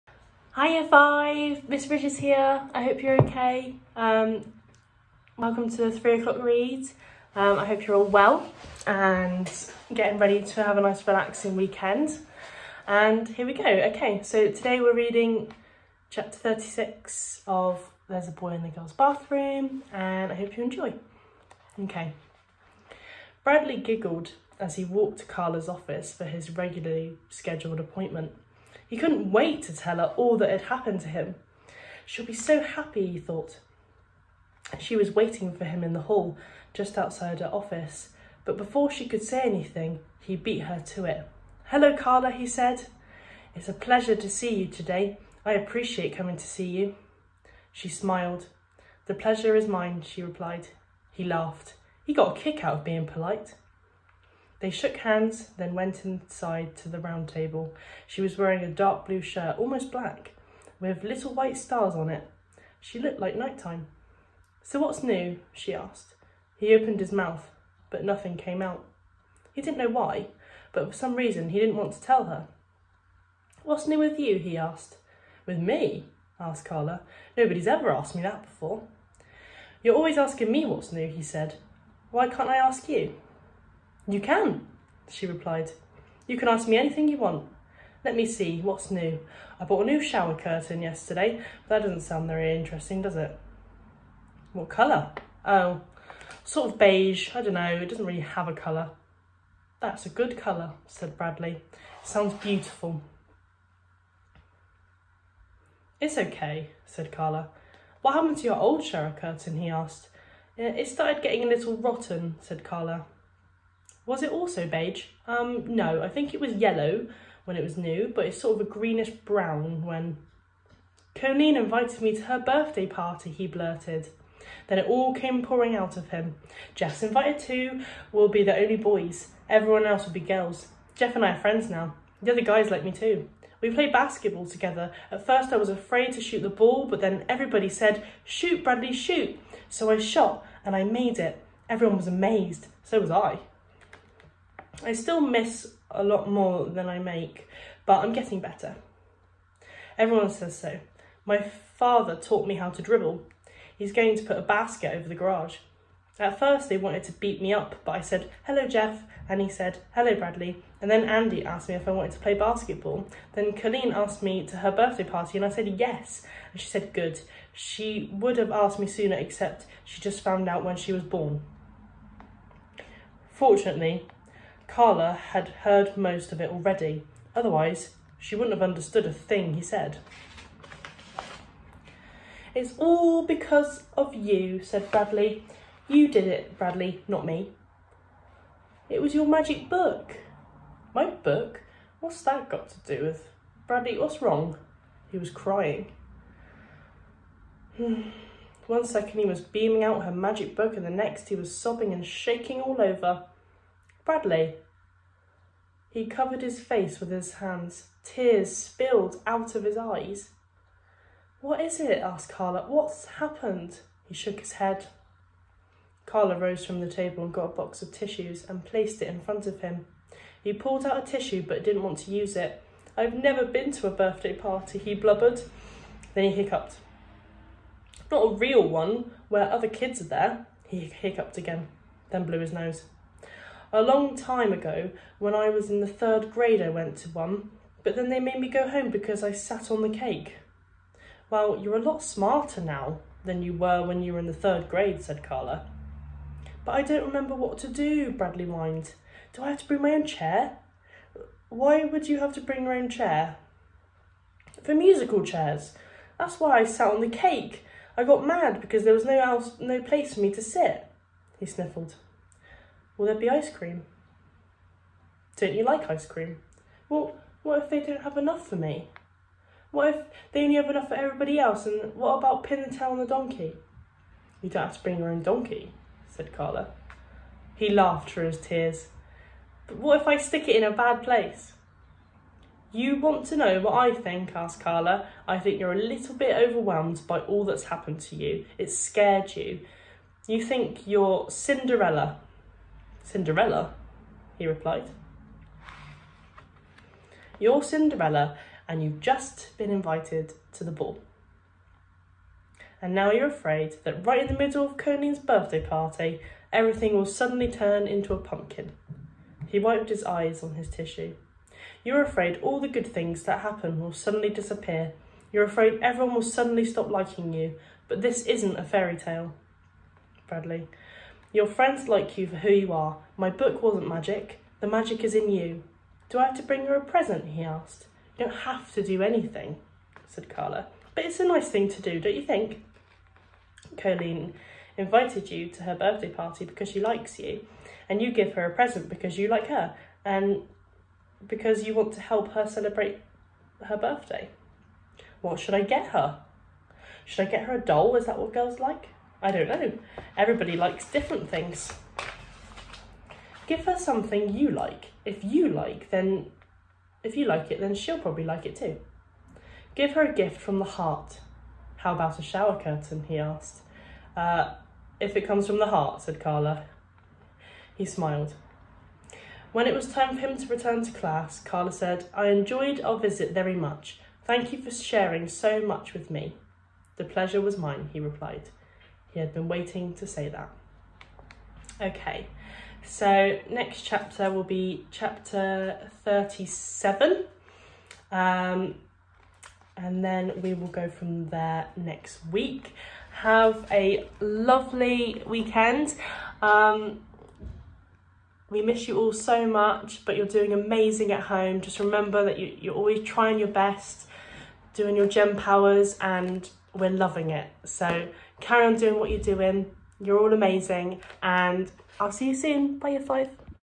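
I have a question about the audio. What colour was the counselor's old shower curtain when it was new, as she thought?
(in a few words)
yellow.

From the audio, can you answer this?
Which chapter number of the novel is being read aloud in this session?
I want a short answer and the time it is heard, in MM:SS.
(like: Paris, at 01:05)
36, at 00:16.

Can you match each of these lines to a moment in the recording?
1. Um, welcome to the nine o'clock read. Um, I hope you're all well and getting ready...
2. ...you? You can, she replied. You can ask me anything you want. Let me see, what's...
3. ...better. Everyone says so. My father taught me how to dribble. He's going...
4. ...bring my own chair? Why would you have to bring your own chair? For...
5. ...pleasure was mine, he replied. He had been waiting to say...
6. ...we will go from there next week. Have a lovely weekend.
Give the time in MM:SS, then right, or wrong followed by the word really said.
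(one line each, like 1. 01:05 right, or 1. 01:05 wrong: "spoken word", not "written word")
1. 00:03 wrong: "three", not "nine"
2. 01:22 right
3. 02:28 right
4. 04:09 right
5. 06:17 right
6. 06:30 right.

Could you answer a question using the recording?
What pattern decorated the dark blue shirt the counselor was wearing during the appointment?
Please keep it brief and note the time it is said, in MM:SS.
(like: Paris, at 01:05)
little white stars, at 01:01.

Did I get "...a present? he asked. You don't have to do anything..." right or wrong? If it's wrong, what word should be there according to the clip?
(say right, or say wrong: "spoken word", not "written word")
right.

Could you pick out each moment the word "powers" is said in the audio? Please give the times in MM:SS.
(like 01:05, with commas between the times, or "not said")
06:45.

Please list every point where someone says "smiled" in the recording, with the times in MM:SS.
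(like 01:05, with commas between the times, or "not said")
00:47, 06:07.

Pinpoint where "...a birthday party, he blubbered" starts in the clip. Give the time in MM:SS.
03:43.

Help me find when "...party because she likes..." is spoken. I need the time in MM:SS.
05:36.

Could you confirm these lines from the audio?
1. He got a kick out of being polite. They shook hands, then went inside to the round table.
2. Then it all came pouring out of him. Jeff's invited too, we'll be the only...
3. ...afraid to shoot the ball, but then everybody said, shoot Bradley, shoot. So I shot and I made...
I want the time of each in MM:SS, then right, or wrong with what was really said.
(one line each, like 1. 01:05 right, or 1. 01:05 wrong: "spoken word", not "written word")
1. 00:52 right
2. 02:04 right
3. 02:15 right.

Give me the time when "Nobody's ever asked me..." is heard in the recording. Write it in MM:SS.
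01:17.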